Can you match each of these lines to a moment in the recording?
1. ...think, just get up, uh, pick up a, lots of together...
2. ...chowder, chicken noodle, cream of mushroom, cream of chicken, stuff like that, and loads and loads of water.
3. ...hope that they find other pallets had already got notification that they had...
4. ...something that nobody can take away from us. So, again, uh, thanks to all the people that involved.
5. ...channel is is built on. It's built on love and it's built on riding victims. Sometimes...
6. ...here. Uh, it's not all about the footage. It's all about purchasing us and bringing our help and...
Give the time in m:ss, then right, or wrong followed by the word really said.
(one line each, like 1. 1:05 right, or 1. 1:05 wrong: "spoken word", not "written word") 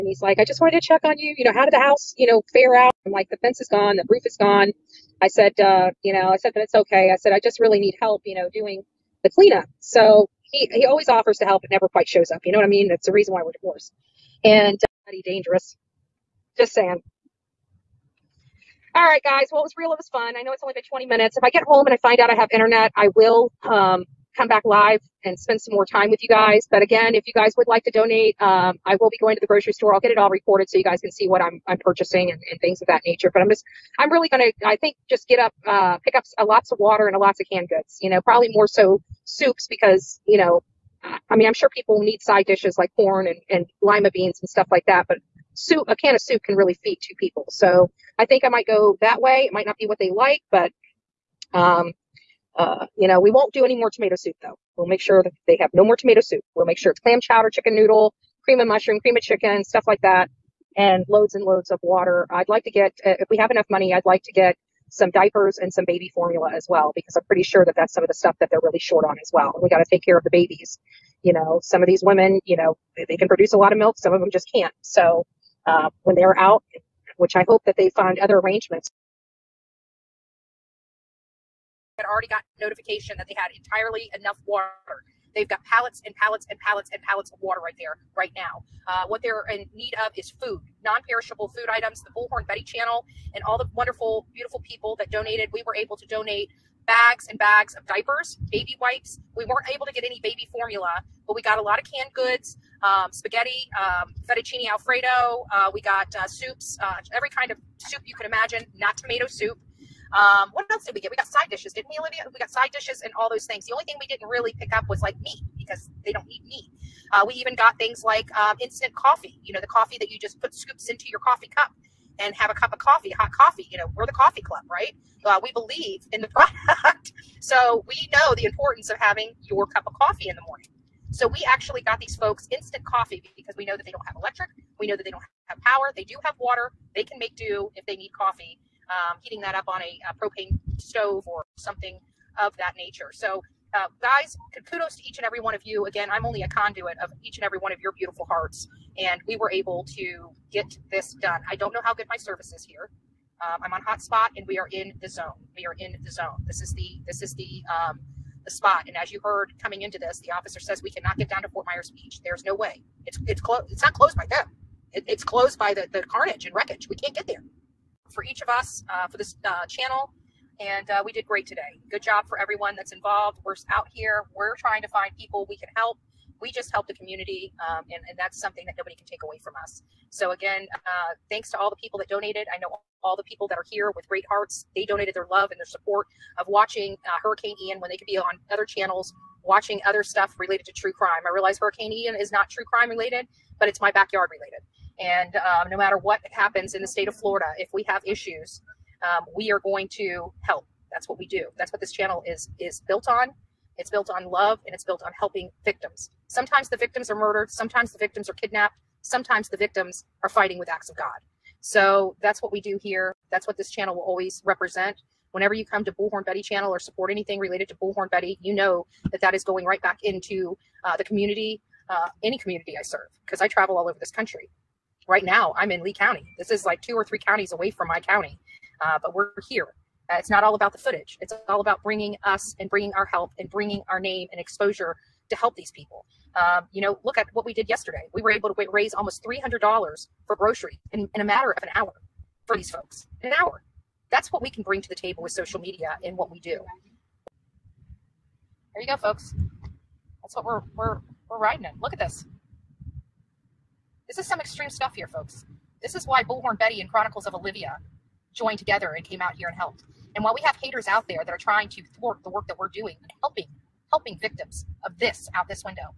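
1. 0:34 wrong: "water", not "together"
2. 0:57 right
3. 1:17 wrong: "arrangements", not "pallets"
4. 2:58 wrong: "donated", not "involved"
5. 3:21 wrong: "helping", not "riding"
6. 3:49 wrong: "bringing", not "purchasing".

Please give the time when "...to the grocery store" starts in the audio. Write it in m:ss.
0:29.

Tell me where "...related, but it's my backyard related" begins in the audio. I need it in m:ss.
3:12.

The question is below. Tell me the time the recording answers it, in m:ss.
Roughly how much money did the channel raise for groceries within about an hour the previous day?
3:59.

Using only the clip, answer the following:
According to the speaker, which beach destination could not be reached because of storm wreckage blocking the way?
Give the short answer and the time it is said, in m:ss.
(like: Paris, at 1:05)
Fort Myers Beach, at 2:41.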